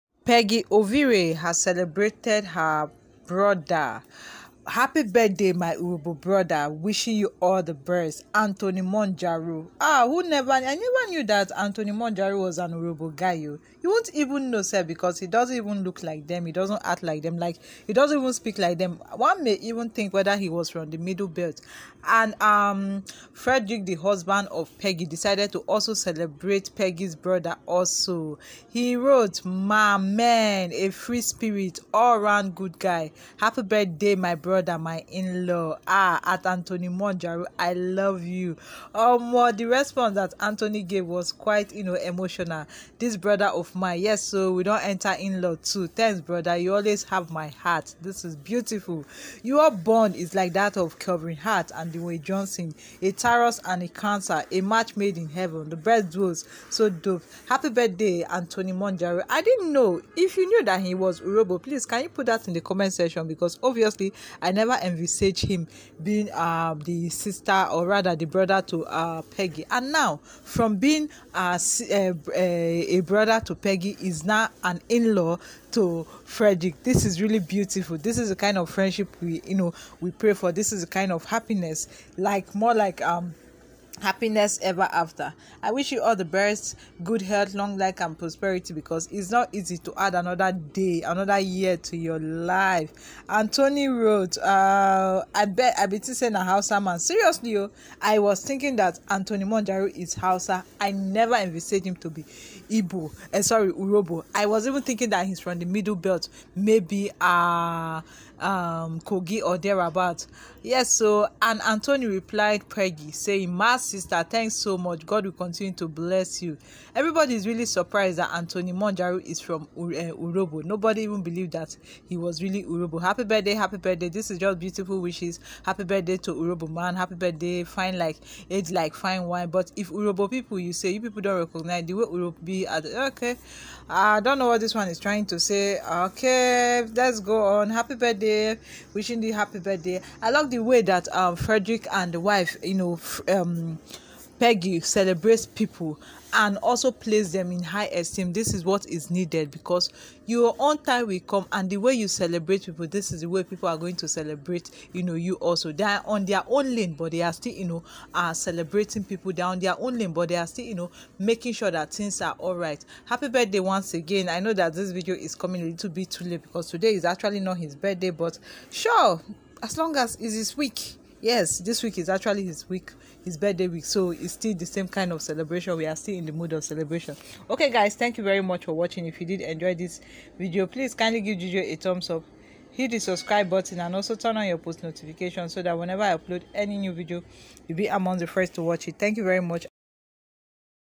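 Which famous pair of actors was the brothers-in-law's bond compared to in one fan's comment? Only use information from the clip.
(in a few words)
Kelvin Hart and Dwayne Johnson.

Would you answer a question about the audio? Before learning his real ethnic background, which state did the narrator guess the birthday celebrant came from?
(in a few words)
Kogi.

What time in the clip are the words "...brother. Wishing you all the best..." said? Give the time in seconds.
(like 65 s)
6 s.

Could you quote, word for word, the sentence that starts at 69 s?
And now, from being a, uh, a, uh, uh, a brother to Peggy, is now an in law to Frederick.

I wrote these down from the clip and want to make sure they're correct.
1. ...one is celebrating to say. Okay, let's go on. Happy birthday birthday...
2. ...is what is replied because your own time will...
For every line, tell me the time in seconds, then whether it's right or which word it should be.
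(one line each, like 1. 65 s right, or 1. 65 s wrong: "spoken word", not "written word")
1. 134 s wrong: "trying", not "celebrating"
2. 148 s wrong: "needed", not "replied".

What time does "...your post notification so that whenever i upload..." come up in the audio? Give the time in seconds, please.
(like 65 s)
184 s.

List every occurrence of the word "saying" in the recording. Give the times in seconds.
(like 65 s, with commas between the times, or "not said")
96 s, 113 s.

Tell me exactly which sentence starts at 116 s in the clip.
Everybody is really surprised that Anthony Monjaro is from uh, Urhobo.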